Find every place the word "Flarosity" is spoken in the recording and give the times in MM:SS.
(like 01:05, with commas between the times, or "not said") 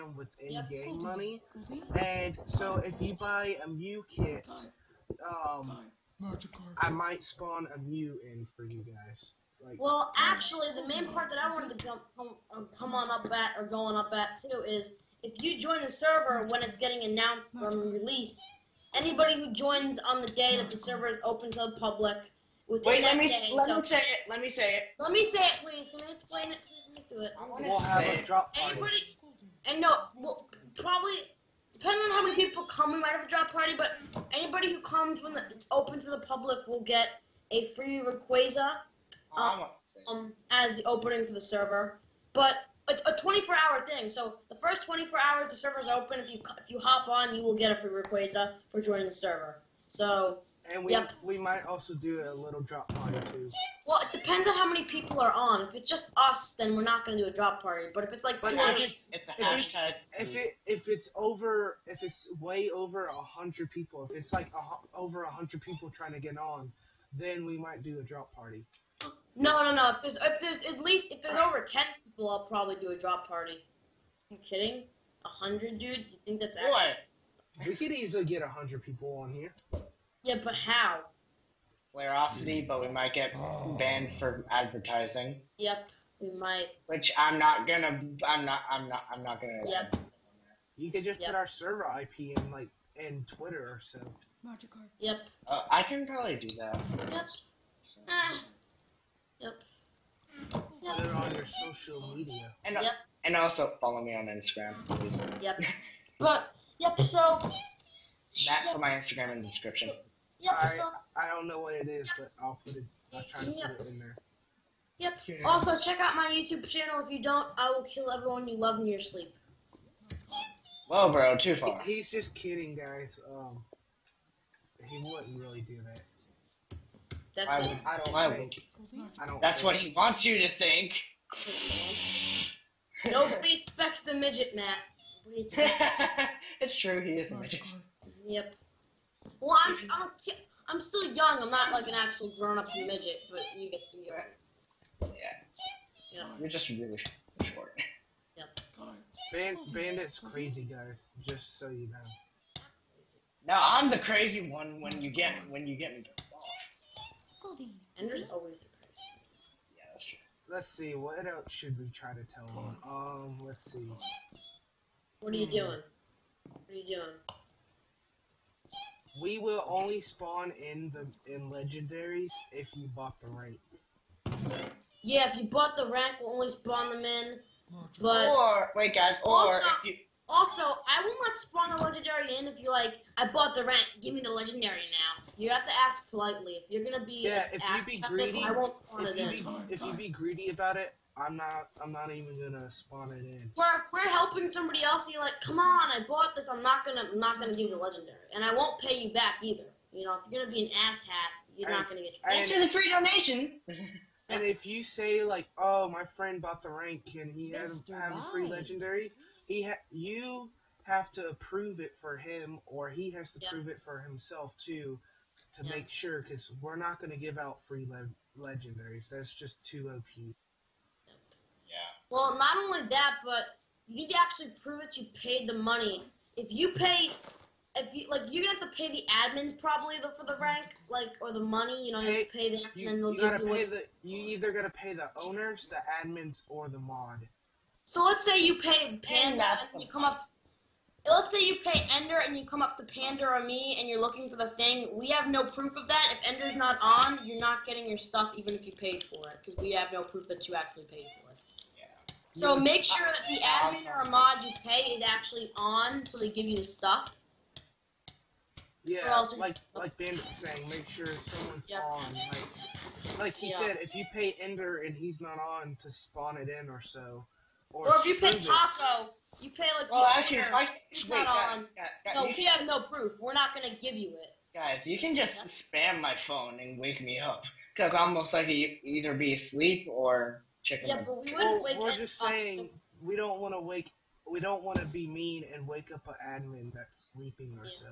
01:21.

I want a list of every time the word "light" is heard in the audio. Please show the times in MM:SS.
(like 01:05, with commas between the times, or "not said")
not said.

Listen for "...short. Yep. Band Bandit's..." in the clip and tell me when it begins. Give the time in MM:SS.
02:27.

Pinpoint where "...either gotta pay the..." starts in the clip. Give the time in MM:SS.
03:54.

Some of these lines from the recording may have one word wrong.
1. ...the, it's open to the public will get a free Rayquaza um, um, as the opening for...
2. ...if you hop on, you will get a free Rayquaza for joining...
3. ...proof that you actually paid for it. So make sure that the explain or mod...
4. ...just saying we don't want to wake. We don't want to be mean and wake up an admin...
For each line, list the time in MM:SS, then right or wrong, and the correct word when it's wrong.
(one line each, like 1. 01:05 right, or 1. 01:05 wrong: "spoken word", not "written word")
1. 00:35 right
2. 00:46 right
3. 04:10 wrong: "admin", not "explain"
4. 04:41 right.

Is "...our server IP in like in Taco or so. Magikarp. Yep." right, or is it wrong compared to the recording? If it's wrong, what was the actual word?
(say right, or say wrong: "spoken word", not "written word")
wrong: "Twitter", not "Taco".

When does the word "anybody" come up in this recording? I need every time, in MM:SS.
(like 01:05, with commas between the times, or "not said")
00:18, 00:28, 00:34.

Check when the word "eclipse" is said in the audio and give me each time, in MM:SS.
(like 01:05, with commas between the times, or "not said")
not said.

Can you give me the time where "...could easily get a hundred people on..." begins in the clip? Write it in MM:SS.
01:17.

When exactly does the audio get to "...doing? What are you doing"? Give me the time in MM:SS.
02:45.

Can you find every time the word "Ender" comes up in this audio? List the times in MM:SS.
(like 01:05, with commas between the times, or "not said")
04:01, 04:06, 04:24, 04:30.